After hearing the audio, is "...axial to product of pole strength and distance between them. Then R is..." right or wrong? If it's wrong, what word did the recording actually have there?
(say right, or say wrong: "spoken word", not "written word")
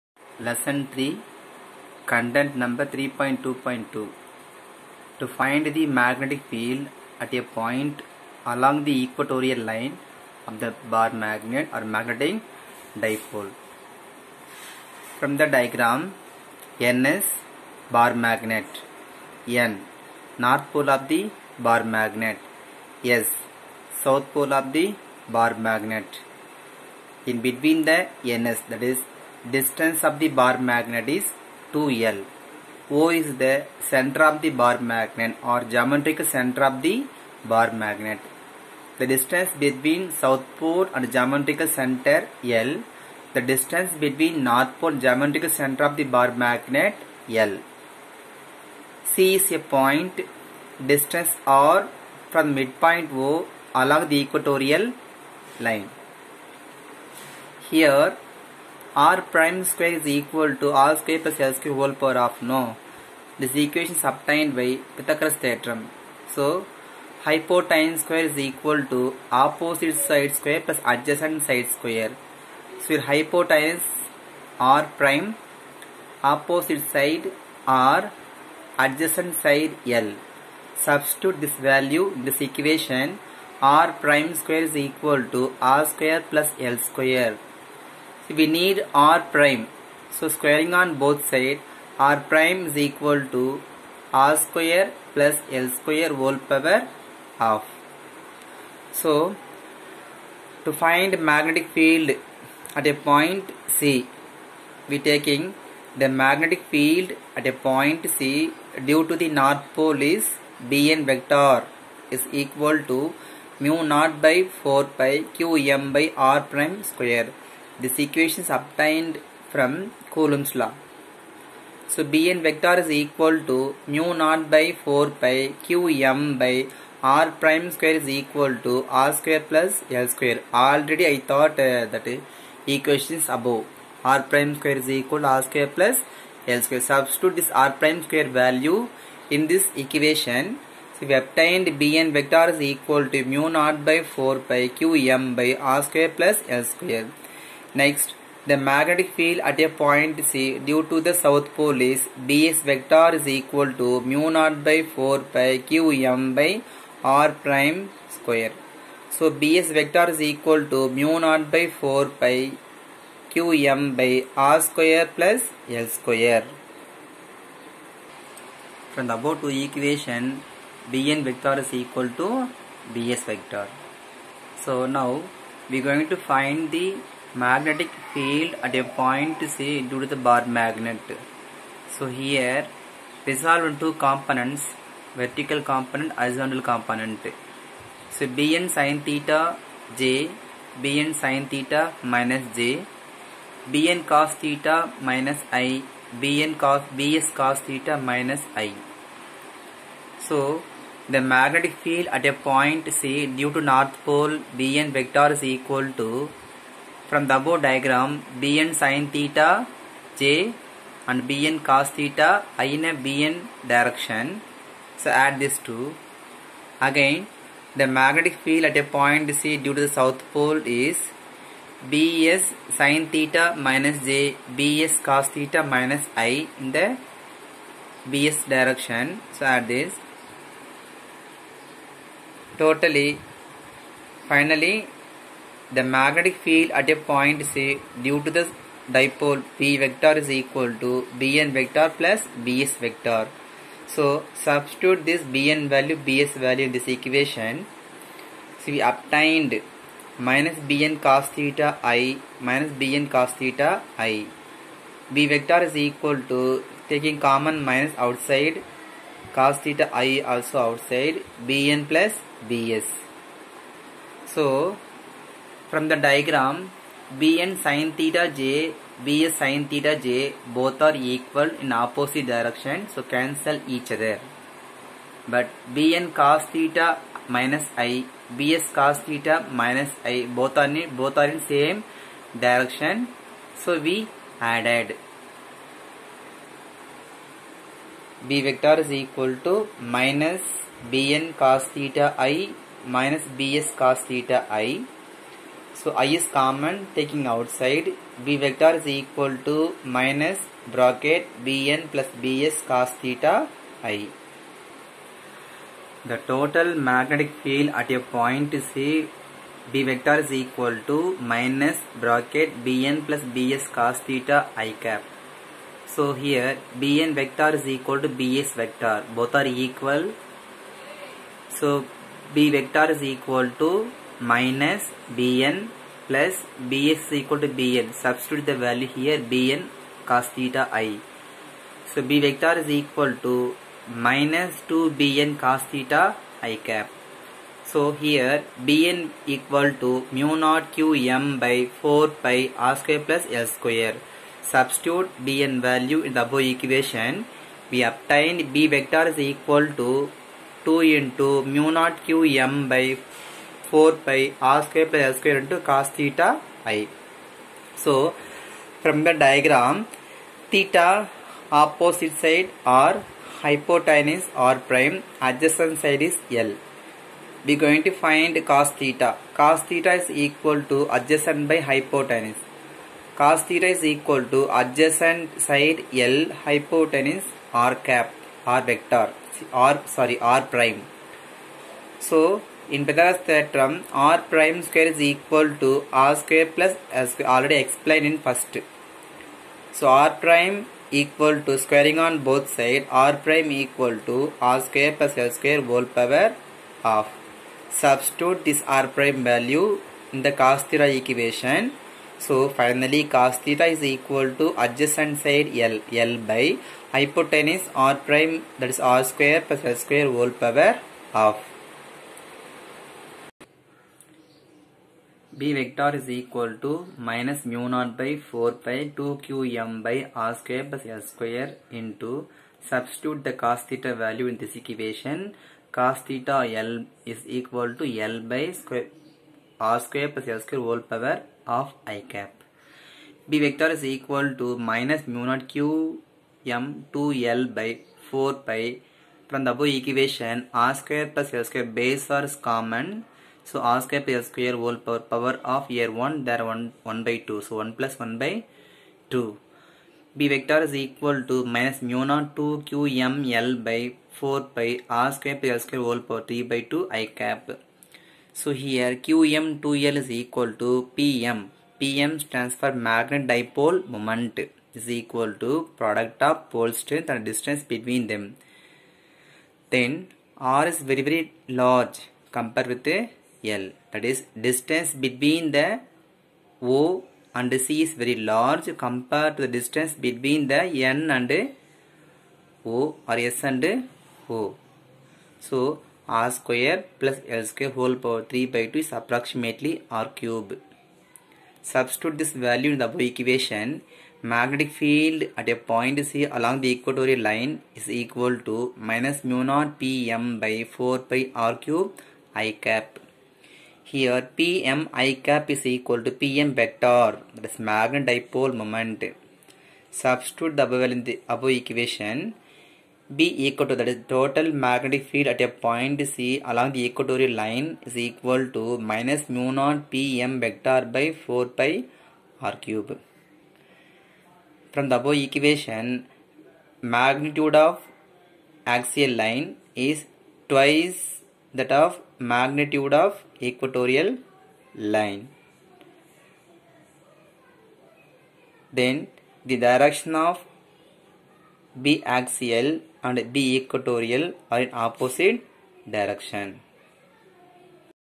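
wrong: "equal", not "axial".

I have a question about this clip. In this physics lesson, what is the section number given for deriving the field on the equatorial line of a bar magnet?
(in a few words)
3.2.2.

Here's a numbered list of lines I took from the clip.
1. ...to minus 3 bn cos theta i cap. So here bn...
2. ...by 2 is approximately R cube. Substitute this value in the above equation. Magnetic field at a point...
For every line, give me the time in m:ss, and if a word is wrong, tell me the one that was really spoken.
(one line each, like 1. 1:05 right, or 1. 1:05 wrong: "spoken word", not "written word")
1. 5:33 wrong: "2", not "3"
2. 8:08 right.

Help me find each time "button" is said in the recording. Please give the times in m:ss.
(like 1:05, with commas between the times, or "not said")
not said.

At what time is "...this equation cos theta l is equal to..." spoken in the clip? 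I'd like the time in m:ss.
7:04.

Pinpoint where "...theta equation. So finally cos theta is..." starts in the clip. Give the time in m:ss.
6:40.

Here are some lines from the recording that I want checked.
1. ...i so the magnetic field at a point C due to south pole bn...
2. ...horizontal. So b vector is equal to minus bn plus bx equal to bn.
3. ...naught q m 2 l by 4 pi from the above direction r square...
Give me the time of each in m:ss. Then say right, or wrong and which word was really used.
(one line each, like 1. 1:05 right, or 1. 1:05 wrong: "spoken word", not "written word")
1. 3:18 wrong: "north", not "south"
2. 5:19 wrong: "equal", not "horizontal"
3. 7:15 wrong: "equation", not "direction".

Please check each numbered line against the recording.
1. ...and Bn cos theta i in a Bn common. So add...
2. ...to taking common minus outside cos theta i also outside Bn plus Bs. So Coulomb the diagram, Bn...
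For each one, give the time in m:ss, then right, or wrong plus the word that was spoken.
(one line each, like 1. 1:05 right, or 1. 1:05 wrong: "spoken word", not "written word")
1. 3:31 wrong: "direction", not "common"
2. 4:16 wrong: "From", not "Coulomb".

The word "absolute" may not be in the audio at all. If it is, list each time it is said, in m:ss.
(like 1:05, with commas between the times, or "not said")
not said.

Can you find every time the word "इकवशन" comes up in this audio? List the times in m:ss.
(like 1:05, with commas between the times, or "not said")
1:03, 1:22.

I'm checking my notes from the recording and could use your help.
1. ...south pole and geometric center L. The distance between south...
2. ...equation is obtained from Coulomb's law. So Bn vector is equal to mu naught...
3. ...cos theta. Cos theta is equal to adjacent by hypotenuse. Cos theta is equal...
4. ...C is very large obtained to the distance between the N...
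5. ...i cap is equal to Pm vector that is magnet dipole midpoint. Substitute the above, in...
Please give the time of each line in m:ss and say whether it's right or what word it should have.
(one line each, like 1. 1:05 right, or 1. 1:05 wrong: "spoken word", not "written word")
1. 0:40 wrong: "north", not "south"
2. 1:57 right
3. 6:08 right
4. 7:57 wrong: "compared", not "obtained"
5. 8:24 wrong: "moment", not "midpoint".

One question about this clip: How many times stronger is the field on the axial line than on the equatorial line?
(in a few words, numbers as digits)
twice.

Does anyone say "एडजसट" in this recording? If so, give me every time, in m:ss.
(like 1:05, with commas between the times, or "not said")
1:10, 1:18.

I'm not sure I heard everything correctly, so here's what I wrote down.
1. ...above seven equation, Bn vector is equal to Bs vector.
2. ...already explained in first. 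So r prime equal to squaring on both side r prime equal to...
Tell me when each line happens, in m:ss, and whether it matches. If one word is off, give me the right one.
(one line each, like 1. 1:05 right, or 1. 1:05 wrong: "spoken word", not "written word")
1. 2:49 wrong: "two", not "seven"
2. 6:27 right.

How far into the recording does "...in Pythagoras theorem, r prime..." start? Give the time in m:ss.
6:22.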